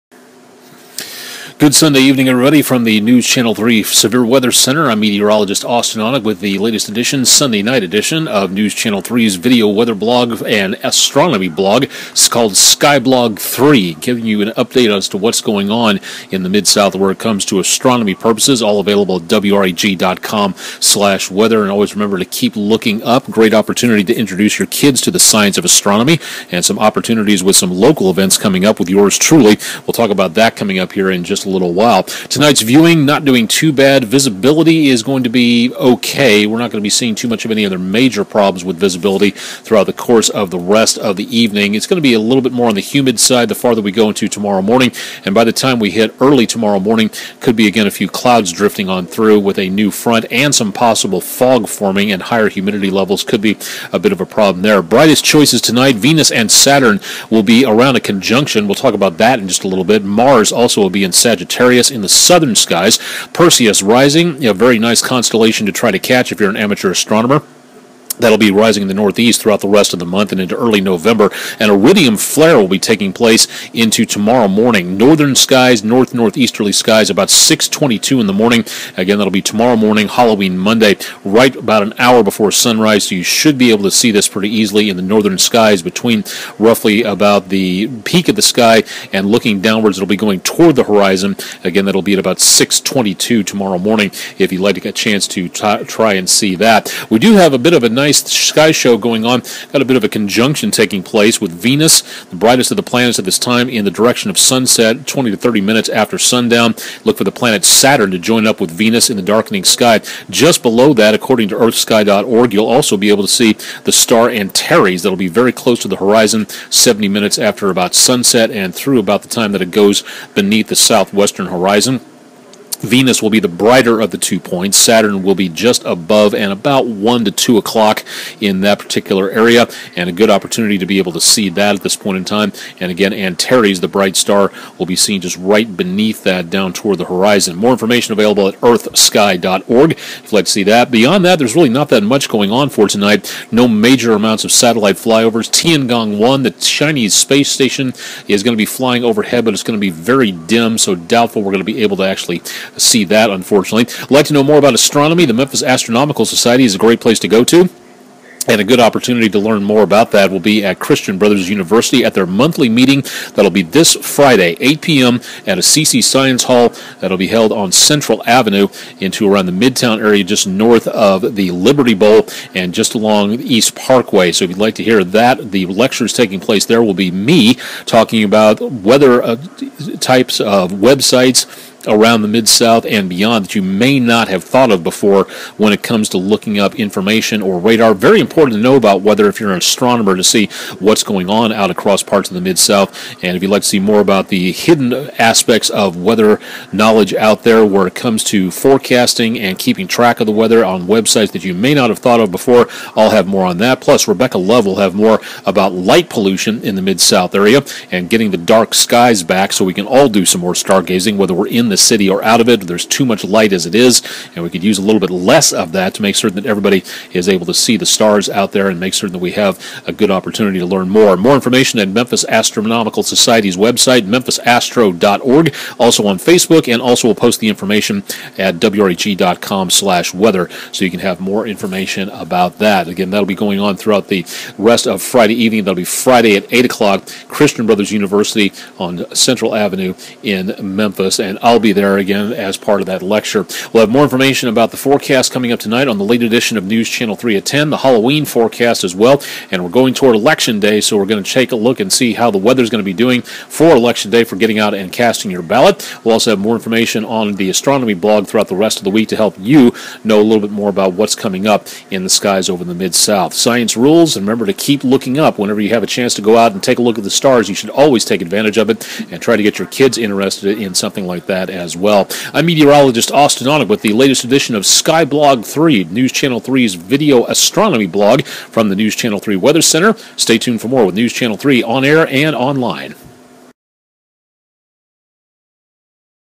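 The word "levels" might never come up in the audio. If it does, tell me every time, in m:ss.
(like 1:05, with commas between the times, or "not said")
0:52.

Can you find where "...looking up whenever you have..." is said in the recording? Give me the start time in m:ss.
4:24.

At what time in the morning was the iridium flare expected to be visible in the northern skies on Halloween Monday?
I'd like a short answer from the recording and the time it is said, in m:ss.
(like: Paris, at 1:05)
6:22, at 1:17.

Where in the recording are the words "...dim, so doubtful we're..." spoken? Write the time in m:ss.
2:30.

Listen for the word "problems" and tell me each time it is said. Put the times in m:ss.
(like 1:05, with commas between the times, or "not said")
0:38, 0:54.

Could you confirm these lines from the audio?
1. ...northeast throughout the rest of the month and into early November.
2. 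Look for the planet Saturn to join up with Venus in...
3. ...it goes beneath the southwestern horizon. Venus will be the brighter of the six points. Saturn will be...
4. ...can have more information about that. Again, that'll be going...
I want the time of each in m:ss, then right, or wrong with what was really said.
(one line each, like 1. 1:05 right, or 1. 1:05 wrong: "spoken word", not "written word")
1. 1:08 right
2. 1:47 right
3. 1:59 wrong: "two", not "six"
4. 3:50 right.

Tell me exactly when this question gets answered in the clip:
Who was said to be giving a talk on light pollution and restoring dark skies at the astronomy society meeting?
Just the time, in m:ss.
3:24.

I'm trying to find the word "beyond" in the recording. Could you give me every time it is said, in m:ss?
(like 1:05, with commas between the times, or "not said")
2:20, 3:03.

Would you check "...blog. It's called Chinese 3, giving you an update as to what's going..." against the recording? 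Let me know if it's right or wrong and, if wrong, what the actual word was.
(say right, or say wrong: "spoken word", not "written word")
wrong: "Skyblog", not "Chinese".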